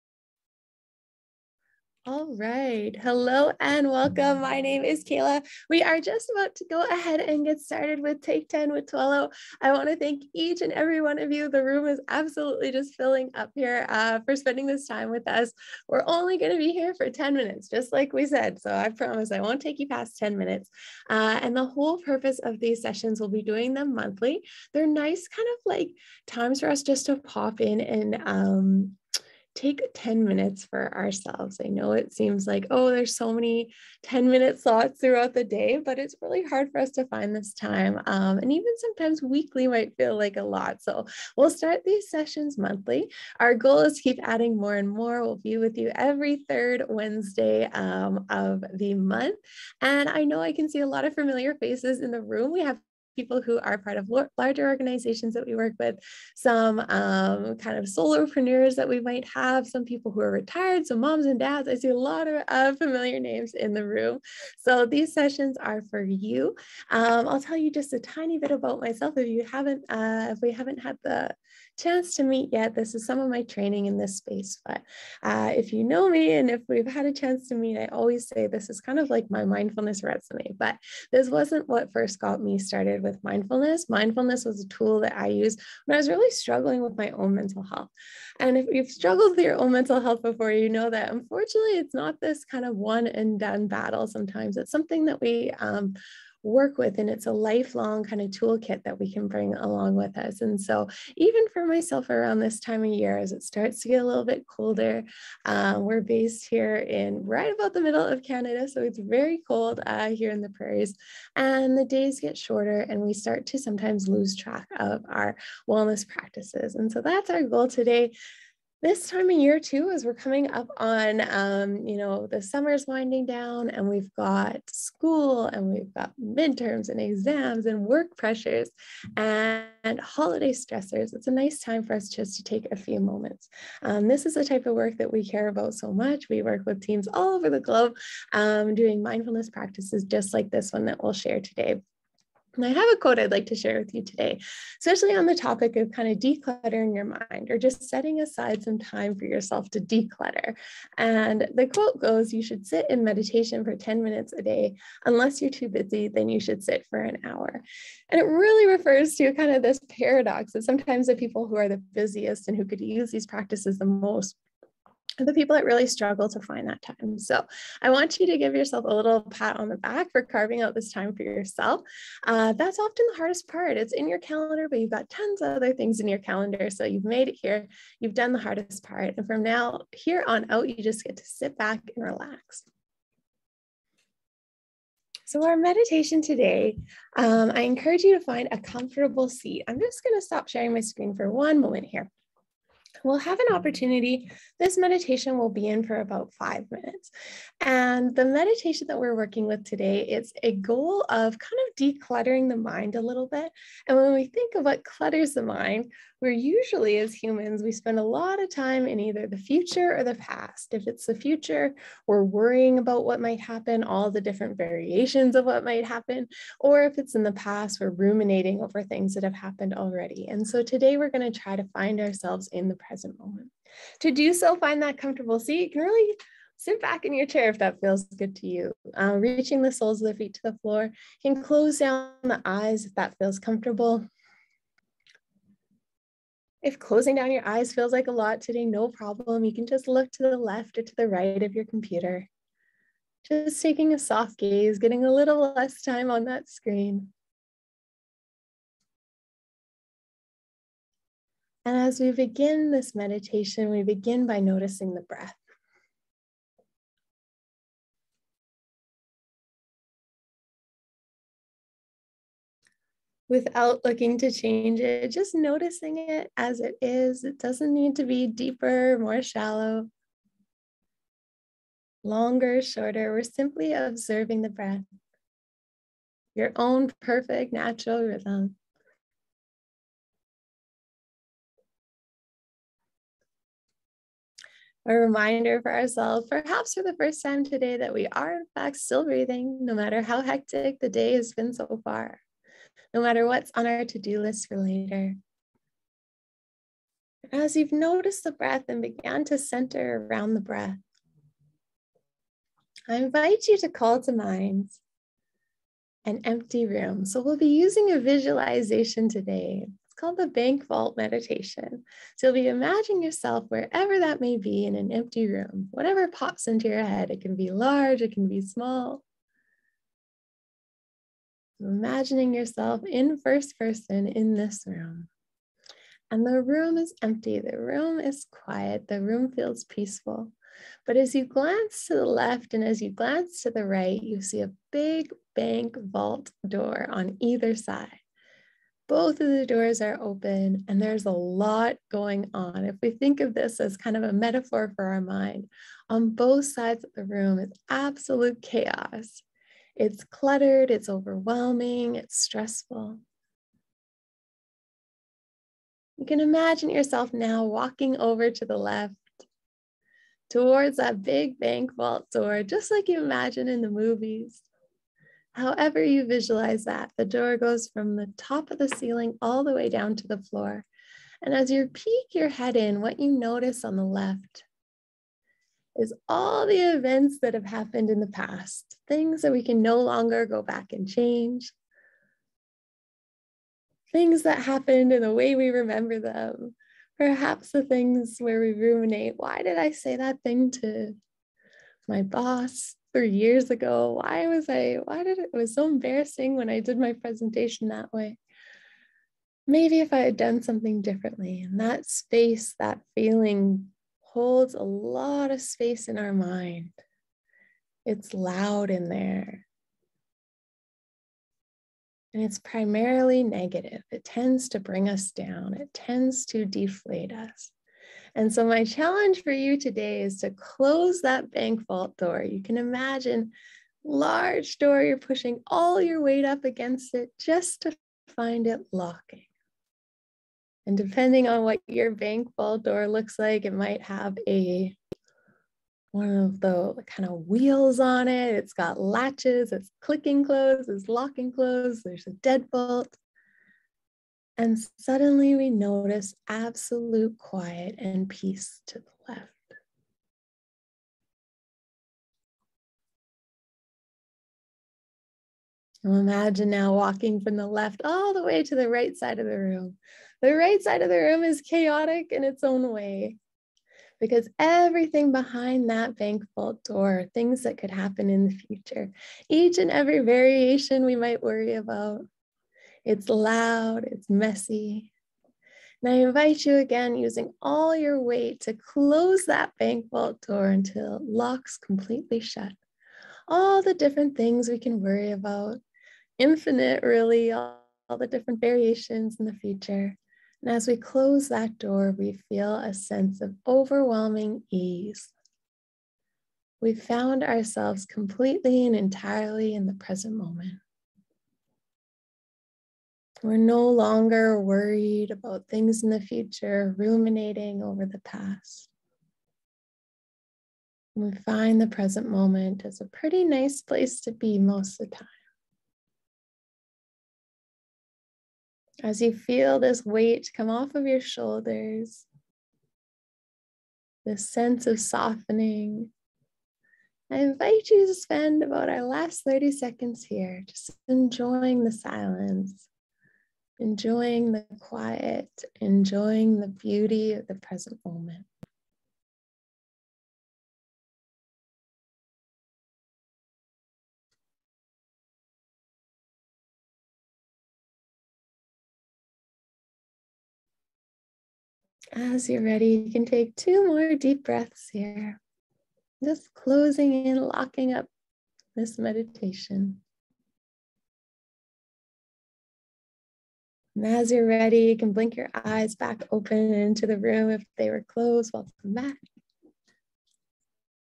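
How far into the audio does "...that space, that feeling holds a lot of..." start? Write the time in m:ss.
6:41.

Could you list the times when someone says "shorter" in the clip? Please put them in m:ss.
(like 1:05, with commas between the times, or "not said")
1:52, 4:32.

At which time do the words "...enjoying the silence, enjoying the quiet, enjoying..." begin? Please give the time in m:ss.
8:50.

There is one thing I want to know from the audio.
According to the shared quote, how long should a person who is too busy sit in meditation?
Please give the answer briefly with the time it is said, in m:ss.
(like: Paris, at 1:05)
an hour, at 2:37.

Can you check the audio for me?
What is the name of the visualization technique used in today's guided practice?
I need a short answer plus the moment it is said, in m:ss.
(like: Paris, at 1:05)
bank vault meditation, at 5:10.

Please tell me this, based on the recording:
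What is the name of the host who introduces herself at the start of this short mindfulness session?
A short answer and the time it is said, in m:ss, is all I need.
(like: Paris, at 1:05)
Kayla, at 0:05.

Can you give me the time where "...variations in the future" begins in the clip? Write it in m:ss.
8:08.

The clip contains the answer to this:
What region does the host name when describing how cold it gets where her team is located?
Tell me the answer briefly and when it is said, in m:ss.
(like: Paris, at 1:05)
the prairies, at 1:50.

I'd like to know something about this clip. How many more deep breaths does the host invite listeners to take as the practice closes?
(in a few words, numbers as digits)
2.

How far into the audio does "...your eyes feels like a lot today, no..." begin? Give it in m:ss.
3:57.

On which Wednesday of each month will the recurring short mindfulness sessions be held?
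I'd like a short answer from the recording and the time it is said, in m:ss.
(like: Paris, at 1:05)
third, at 0:46.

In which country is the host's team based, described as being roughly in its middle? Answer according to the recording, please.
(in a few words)
Canada.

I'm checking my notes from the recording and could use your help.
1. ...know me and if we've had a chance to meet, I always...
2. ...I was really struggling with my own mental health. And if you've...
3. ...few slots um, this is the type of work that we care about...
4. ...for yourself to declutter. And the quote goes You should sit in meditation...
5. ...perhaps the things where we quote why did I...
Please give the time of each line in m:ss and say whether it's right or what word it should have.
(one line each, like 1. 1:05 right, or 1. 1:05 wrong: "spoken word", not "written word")
1. 1:15 right
2. 1:25 right
3. 2:12 wrong: "moments", not "slots"
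4. 2:29 right
5. 6:26 wrong: "ruminate", not "quote".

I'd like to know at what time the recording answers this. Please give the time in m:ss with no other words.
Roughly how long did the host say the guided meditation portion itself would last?
3:16.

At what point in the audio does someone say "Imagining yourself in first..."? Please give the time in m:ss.
5:21.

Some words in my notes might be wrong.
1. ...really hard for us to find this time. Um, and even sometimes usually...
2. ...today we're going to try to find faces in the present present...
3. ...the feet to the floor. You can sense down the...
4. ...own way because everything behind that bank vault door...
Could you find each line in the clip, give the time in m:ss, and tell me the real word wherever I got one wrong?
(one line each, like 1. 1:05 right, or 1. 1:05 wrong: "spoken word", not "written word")
1. 0:36 wrong: "weekly", not "usually"
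2. 3:40 wrong: "ourselves", not "faces"
3. 3:50 wrong: "close", not "sense"
4. 7:42 right.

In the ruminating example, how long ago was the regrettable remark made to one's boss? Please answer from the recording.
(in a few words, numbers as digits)
3 years ago.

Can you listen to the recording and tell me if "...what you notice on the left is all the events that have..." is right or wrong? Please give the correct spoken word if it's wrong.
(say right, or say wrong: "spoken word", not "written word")
right.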